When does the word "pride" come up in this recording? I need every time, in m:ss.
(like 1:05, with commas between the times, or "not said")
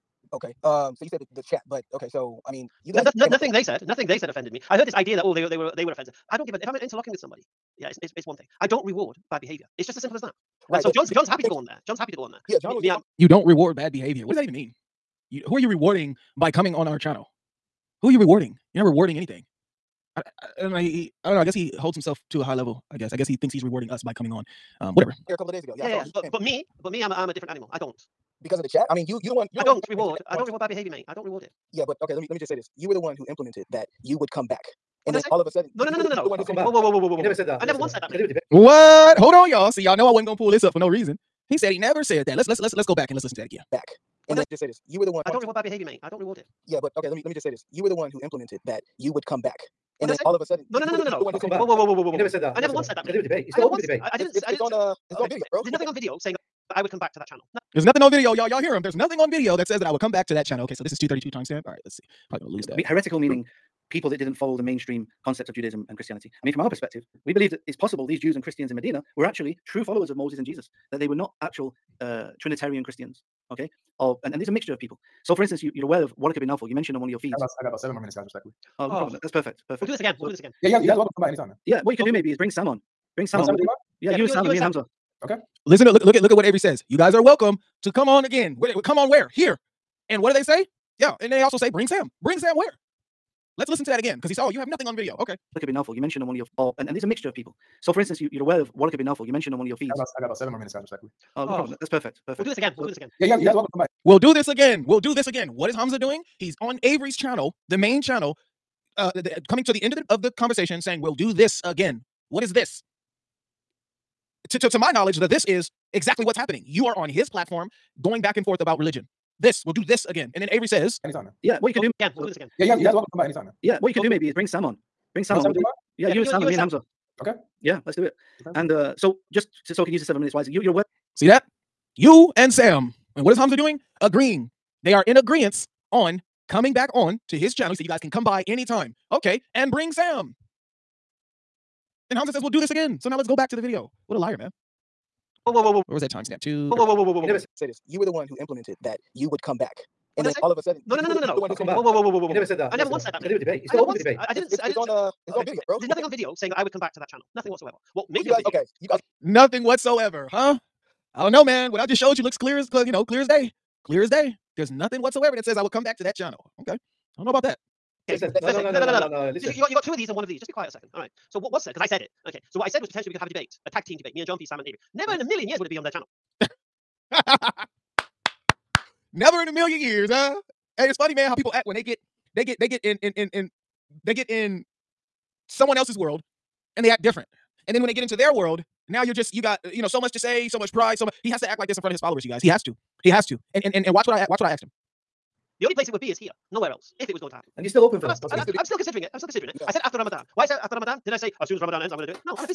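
3:10.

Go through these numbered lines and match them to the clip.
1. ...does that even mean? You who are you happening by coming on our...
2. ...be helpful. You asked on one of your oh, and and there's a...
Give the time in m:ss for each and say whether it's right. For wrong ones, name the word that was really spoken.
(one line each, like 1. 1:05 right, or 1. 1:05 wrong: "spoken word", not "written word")
1. 0:14 wrong: "rewarding", not "happening"
2. 1:35 wrong: "mentioned", not "asked".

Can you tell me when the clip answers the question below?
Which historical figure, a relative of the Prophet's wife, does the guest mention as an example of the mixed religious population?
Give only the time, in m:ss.
1:16.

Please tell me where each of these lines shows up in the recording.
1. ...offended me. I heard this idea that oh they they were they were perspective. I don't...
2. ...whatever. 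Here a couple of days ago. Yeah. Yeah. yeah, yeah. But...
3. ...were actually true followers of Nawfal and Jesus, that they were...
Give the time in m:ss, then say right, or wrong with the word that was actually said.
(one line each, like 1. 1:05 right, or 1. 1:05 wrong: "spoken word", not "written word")
1. 0:04 wrong: "offensive", not "perspective"
2. 0:24 right
3. 1:09 wrong: "Moses", not "Nawfal".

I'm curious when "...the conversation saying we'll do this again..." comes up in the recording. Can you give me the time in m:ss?
1:50.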